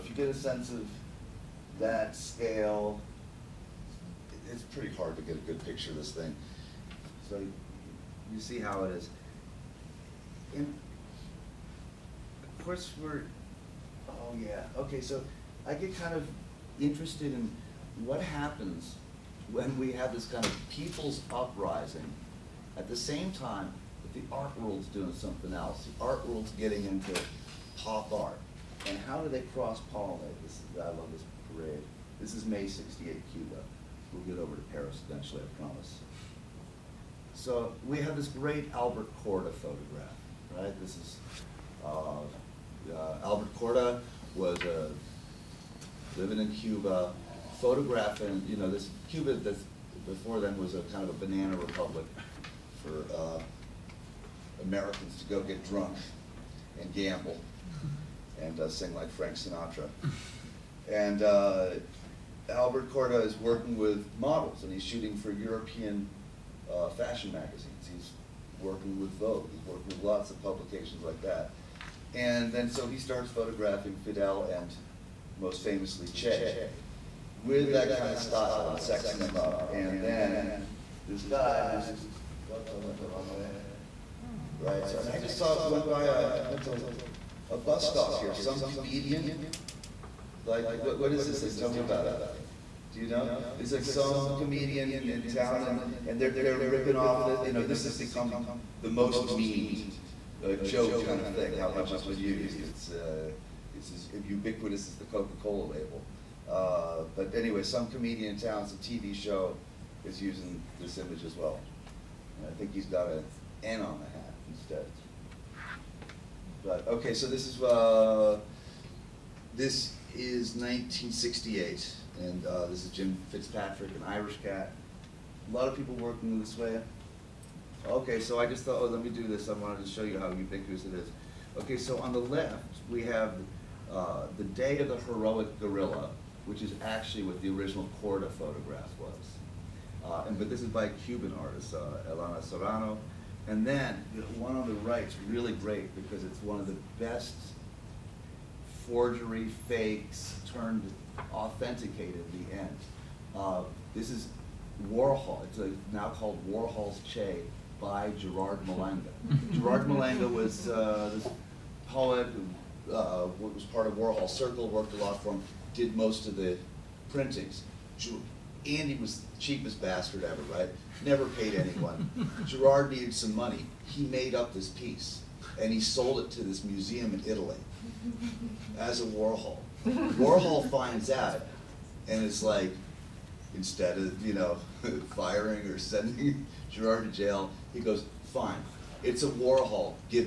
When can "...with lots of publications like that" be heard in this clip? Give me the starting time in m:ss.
1:09.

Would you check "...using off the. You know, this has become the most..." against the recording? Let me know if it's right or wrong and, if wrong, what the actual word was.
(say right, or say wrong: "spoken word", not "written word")
wrong: "ripping", not "using".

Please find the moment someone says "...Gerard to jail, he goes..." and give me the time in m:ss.
3:06.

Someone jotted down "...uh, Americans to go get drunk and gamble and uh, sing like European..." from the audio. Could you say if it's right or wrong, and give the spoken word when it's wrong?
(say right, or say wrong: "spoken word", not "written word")
wrong: "Frank", not "European".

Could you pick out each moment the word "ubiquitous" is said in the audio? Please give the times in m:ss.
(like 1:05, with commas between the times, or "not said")
1:44, 2:10.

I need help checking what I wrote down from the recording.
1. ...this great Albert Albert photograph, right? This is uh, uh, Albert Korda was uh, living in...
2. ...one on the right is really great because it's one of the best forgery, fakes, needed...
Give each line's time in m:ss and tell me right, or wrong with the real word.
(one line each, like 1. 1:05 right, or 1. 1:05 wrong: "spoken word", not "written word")
1. 0:38 wrong: "Korda", not "Albert"
2. 2:24 wrong: "turned", not "needed".